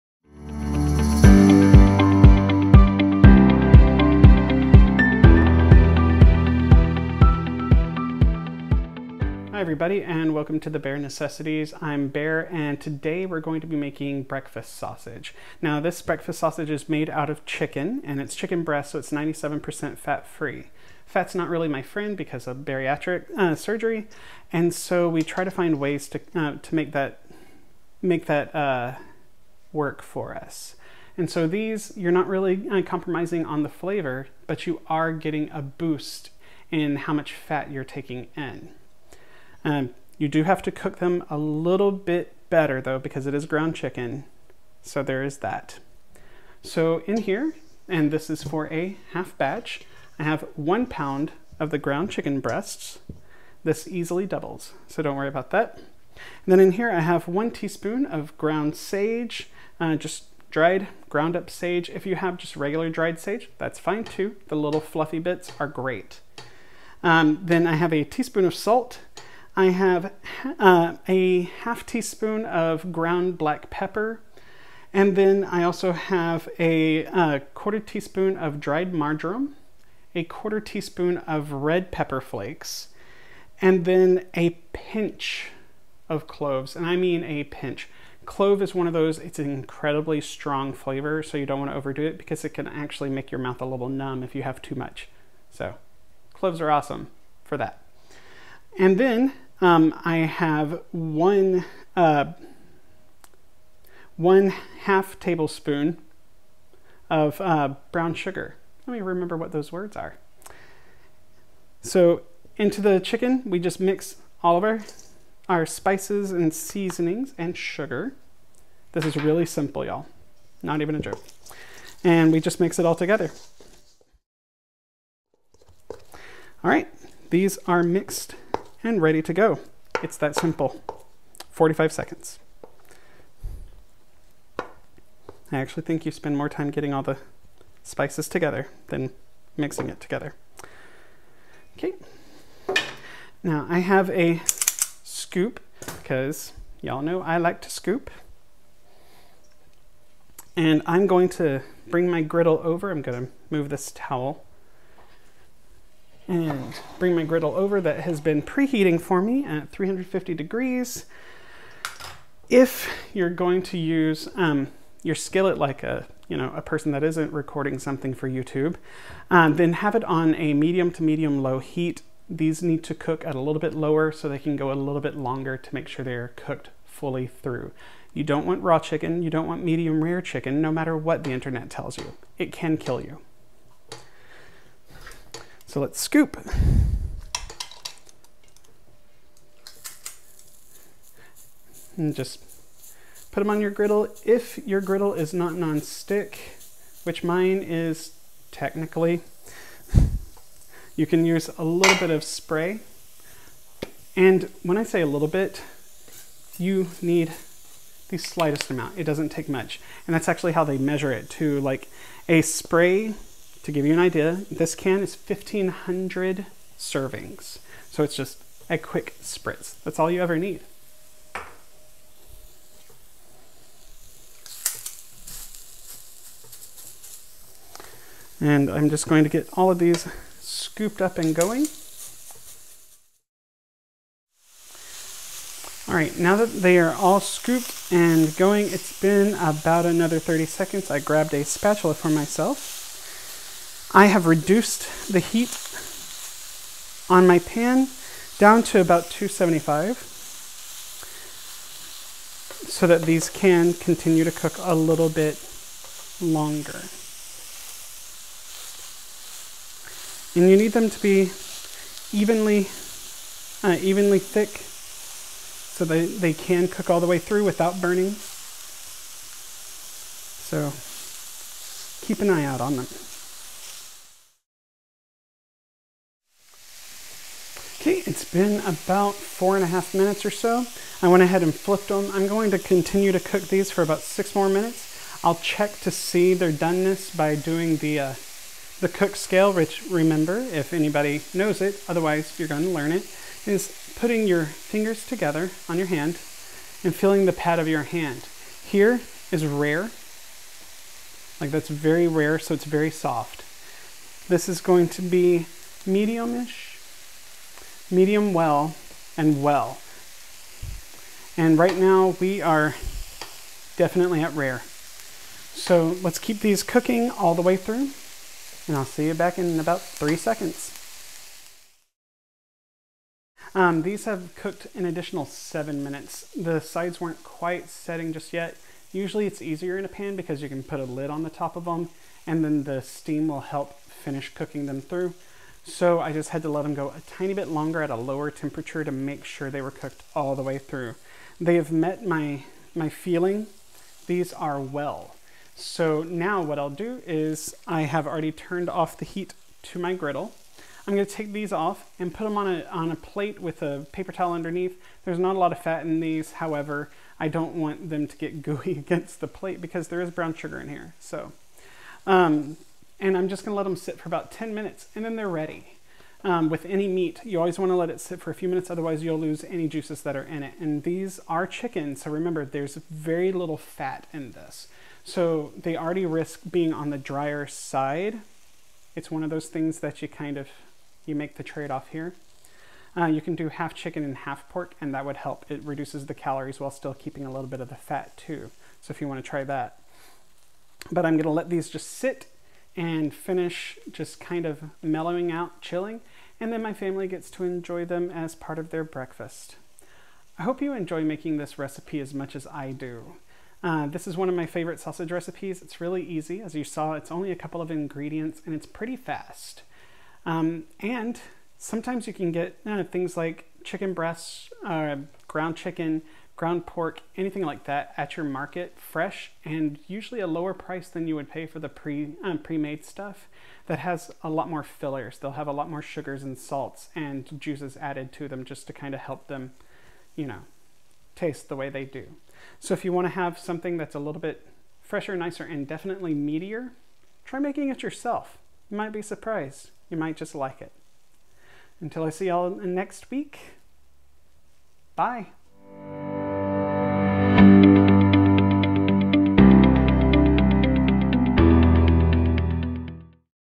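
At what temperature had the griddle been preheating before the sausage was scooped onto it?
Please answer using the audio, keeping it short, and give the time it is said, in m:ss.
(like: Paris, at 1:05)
350 degrees, at 2:39.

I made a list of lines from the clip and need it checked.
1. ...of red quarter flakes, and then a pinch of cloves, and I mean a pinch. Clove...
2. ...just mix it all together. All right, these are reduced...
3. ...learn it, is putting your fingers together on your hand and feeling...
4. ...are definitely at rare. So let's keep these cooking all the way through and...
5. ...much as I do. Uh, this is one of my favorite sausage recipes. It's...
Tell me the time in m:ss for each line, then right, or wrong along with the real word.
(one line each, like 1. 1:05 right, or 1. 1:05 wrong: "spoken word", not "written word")
1. 1:21 wrong: "pepper", not "quarter"
2. 2:02 wrong: "mixed", not "reduced"
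3. 4:52 right
4. 5:12 right
5. 6:42 right.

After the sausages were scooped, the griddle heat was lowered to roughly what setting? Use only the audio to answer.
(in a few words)
275.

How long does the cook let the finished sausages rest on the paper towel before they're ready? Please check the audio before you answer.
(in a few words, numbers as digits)
10 minutes.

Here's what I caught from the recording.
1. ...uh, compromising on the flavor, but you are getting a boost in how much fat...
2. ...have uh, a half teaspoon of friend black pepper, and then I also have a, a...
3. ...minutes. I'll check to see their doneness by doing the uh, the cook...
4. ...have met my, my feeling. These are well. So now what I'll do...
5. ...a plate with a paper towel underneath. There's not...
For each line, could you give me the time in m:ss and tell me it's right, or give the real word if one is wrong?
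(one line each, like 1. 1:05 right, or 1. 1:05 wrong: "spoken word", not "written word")
1. 0:32 right
2. 1:09 wrong: "ground", not "friend"
3. 4:44 right
4. 5:41 right
5. 5:52 right.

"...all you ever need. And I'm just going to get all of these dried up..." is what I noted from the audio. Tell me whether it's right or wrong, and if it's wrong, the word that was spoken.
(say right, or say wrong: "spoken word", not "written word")
wrong: "scooped", not "dried".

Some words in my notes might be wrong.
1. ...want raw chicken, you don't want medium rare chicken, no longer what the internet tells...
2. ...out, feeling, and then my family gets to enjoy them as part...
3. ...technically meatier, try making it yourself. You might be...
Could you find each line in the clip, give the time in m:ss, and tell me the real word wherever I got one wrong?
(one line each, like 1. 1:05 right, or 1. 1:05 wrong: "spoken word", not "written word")
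1. 2:58 wrong: "matter", not "longer"
2. 6:35 wrong: "chilling", not "feeling"
3. 7:15 wrong: "definitely", not "technically".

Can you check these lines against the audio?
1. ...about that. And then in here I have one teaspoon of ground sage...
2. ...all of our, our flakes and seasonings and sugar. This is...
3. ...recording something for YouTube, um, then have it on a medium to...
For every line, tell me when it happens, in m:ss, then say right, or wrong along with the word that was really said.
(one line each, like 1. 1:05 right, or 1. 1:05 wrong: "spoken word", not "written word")
1. 0:55 right
2. 1:54 wrong: "spices", not "flakes"
3. 2:47 right.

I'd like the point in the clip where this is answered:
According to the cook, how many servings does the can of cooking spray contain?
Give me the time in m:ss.
3:35.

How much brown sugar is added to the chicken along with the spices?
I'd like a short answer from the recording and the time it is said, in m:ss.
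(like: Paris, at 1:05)
1/2 tablespoon, at 1:44.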